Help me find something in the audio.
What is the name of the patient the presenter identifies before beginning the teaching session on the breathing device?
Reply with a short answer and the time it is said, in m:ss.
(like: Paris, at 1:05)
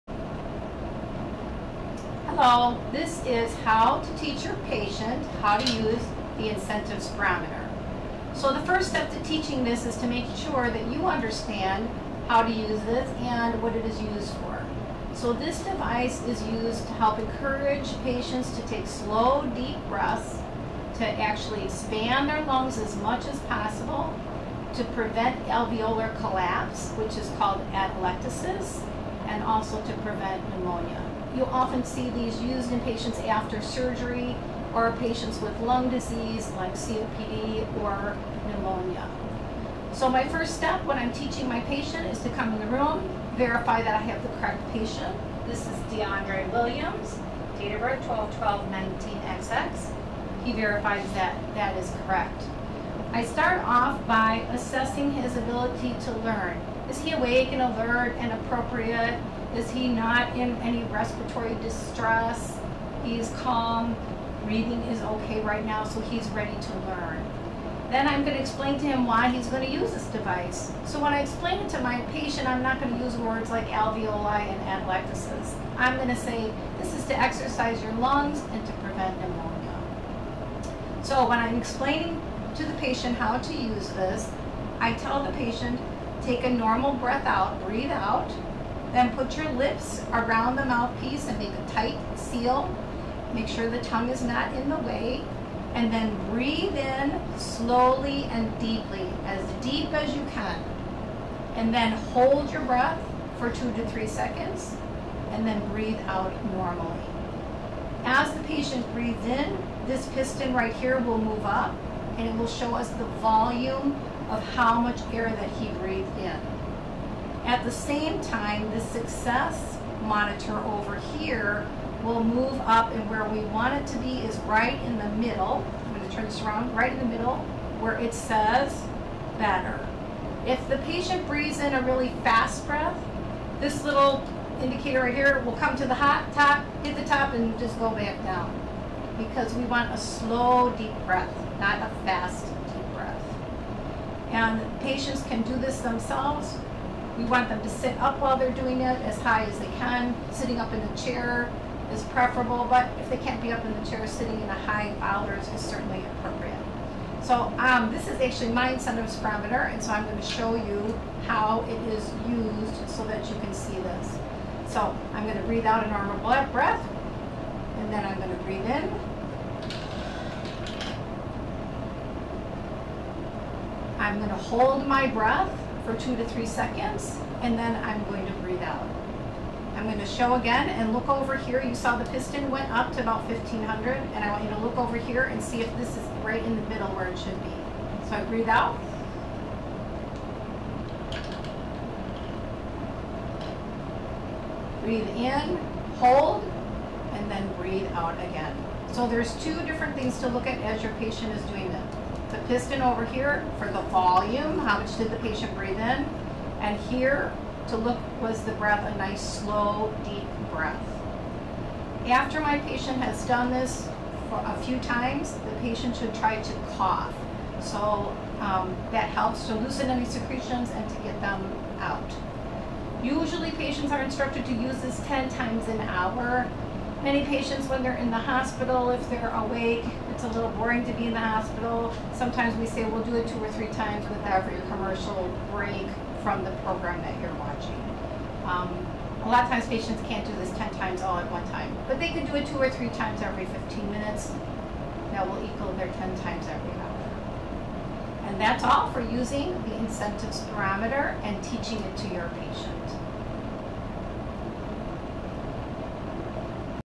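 DeAndre Williams, at 0:45.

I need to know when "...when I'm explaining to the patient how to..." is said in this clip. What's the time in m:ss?
1:21.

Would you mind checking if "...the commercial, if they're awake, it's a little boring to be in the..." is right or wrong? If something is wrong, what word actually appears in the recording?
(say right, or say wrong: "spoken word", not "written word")
wrong: "hospital", not "commercial".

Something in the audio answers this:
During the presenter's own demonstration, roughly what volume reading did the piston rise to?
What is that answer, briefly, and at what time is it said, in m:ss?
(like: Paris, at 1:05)
1500, at 3:03.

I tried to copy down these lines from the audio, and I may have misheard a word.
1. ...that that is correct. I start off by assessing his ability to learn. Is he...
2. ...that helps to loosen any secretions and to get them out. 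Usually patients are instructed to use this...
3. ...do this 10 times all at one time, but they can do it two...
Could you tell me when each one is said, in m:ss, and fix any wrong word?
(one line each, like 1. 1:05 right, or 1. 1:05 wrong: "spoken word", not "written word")
1. 0:51 right
2. 3:38 right
3. 4:00 right.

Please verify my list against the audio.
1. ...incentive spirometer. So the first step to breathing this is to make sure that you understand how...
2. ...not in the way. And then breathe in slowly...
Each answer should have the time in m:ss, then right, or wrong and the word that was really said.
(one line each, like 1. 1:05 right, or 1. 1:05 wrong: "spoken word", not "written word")
1. 0:06 wrong: "teaching", not "breathing"
2. 1:34 right.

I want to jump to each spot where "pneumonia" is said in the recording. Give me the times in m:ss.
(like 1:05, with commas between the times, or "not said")
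0:30, 0:38, 1:19.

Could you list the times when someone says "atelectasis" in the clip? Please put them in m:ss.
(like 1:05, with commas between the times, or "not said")
0:27, 1:14.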